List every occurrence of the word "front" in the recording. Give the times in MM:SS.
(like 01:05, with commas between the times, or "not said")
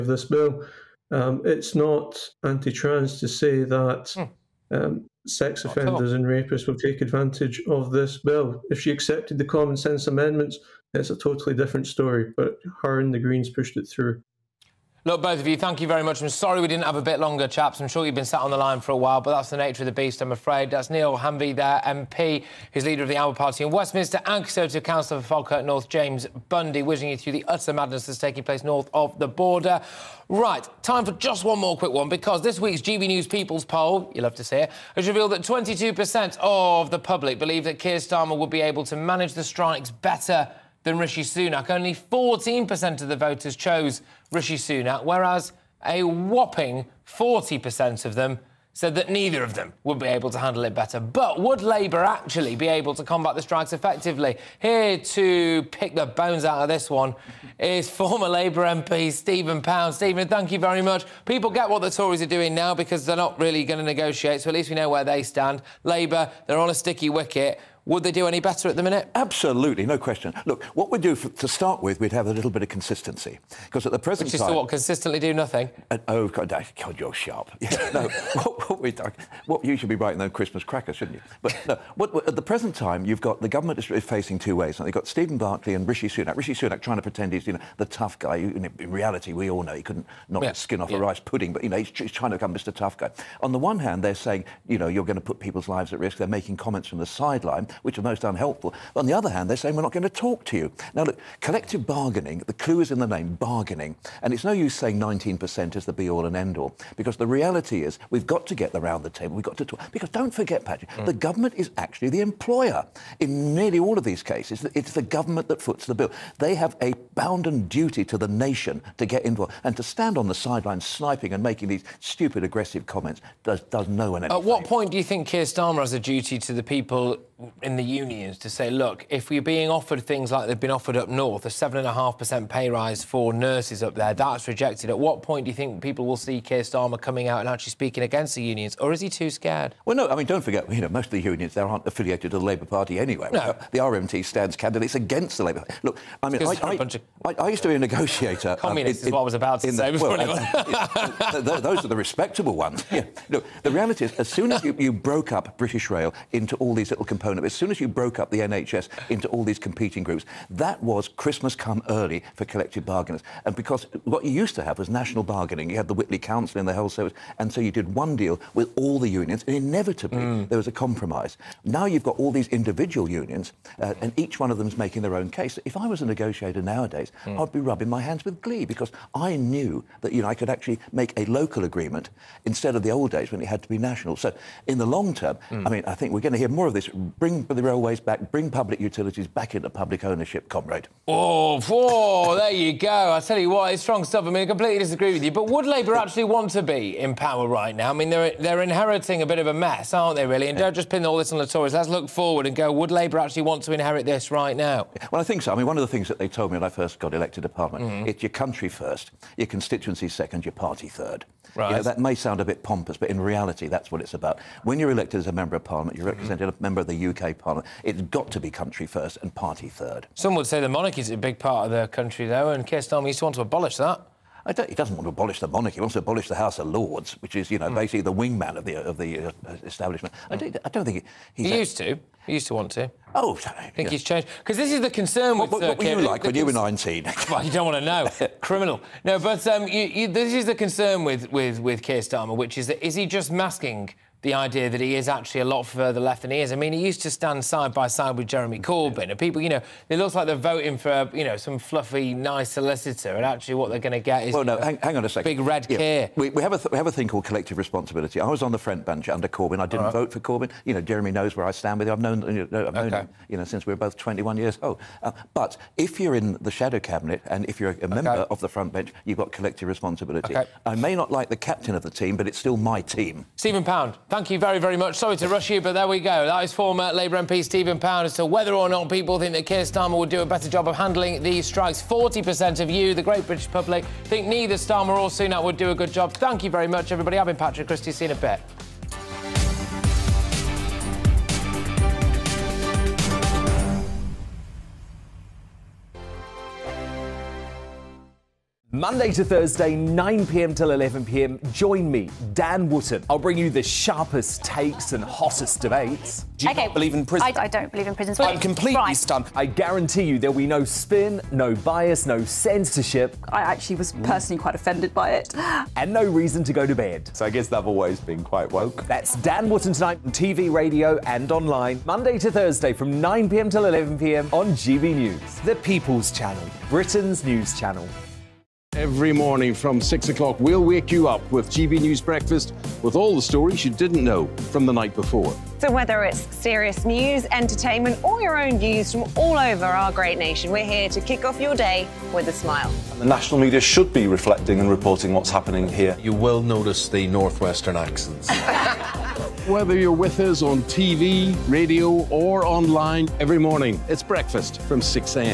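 04:18, 04:28.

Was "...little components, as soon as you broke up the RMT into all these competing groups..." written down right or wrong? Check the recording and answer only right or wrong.
wrong.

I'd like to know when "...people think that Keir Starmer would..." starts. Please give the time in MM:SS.
04:38.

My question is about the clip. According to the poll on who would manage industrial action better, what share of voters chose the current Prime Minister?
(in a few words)
14%.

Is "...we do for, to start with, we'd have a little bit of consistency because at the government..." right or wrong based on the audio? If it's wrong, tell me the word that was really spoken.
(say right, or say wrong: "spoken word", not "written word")
wrong: "present", not "government".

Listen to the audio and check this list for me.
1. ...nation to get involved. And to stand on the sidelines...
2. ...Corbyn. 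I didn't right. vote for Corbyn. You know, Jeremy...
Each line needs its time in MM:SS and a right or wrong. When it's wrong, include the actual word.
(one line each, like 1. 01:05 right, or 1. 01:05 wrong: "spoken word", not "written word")
1. 01:58 right
2. 04:19 right.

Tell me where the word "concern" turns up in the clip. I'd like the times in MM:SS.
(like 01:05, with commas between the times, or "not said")
03:54, 04:00.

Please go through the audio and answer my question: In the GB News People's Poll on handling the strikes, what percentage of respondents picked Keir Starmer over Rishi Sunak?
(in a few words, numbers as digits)
22%.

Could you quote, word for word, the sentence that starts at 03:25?
I mean, one of the things that they told me when I first got elected to Parliament, mm -hmm.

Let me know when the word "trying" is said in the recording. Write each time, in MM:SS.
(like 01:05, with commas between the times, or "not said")
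01:26, 01:32.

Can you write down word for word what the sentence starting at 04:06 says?
I mean, he used to stand side by side with Jeremy Corbyn.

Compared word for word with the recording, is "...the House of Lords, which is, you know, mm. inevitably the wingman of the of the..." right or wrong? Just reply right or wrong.
wrong.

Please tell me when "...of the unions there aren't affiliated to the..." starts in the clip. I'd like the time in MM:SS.
02:21.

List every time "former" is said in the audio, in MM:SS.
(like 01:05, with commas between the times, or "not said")
00:57, 04:36.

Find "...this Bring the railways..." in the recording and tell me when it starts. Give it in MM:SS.
03:06.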